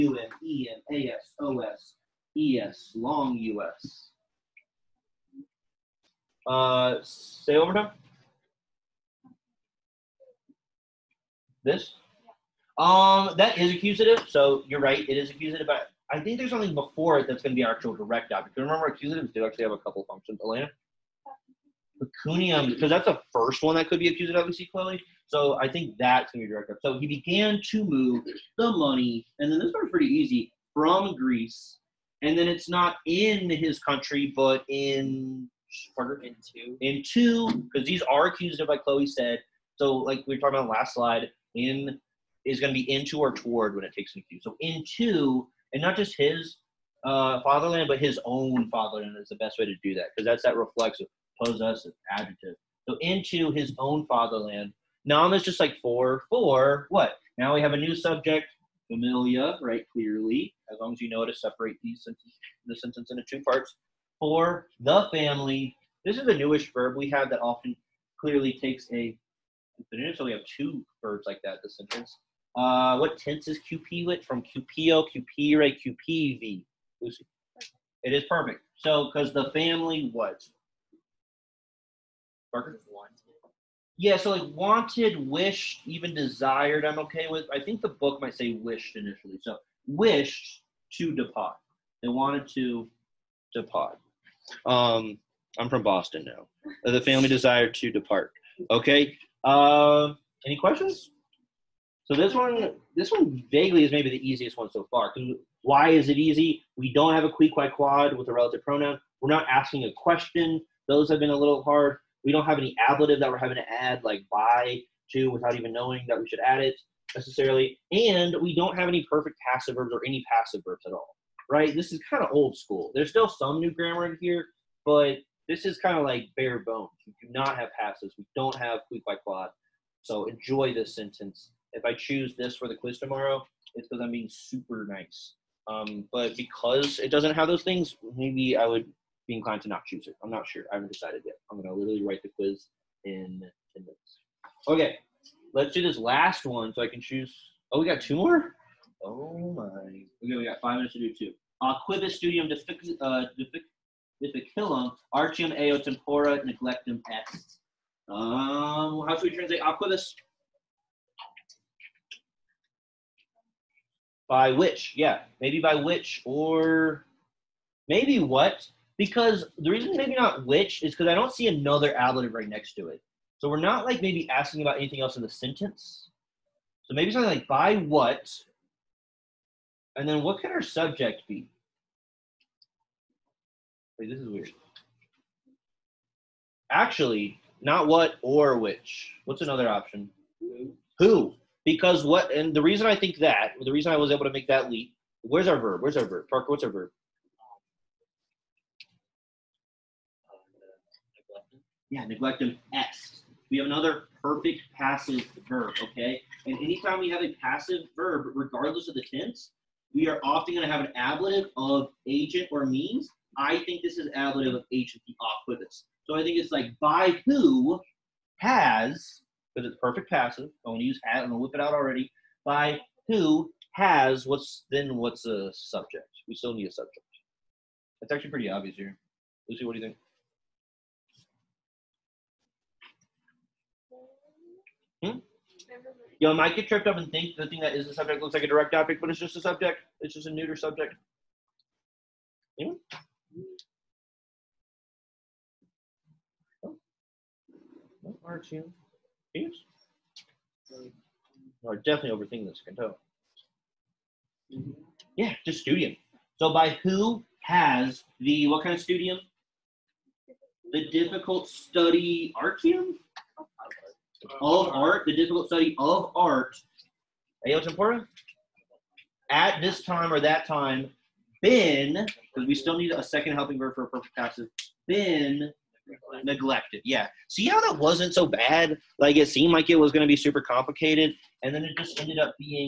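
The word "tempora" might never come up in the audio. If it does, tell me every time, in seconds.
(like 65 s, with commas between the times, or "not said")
155 s, 267 s.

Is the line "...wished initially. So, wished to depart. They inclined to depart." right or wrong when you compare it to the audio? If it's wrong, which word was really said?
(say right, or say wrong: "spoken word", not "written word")
wrong: "wanted", not "inclined".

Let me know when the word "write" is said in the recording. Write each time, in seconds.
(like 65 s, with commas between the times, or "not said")
142 s.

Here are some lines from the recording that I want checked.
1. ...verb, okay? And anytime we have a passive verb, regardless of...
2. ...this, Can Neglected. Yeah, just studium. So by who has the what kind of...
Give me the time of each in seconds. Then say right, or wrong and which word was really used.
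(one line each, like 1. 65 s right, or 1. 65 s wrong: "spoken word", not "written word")
1. 205 s right
2. 252 s wrong: "Kanto", not "Neglected".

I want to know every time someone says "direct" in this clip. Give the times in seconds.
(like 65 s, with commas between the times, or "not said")
17 s, 26 s, 238 s.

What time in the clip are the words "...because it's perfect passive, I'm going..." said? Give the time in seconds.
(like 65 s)
219 s.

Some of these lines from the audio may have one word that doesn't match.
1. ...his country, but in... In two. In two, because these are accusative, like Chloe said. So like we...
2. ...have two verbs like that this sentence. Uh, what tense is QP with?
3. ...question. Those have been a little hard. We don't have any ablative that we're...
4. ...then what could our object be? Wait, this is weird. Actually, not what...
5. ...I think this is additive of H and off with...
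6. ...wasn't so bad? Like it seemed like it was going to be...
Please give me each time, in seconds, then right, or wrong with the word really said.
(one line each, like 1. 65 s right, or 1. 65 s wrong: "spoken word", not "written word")
1. 33 s right
2. 70 s right
3. 109 s right
4. 180 s wrong: "subject", not "object"
5. 213 s right
6. 277 s right.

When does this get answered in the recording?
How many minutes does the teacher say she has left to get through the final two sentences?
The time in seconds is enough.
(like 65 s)
150 s.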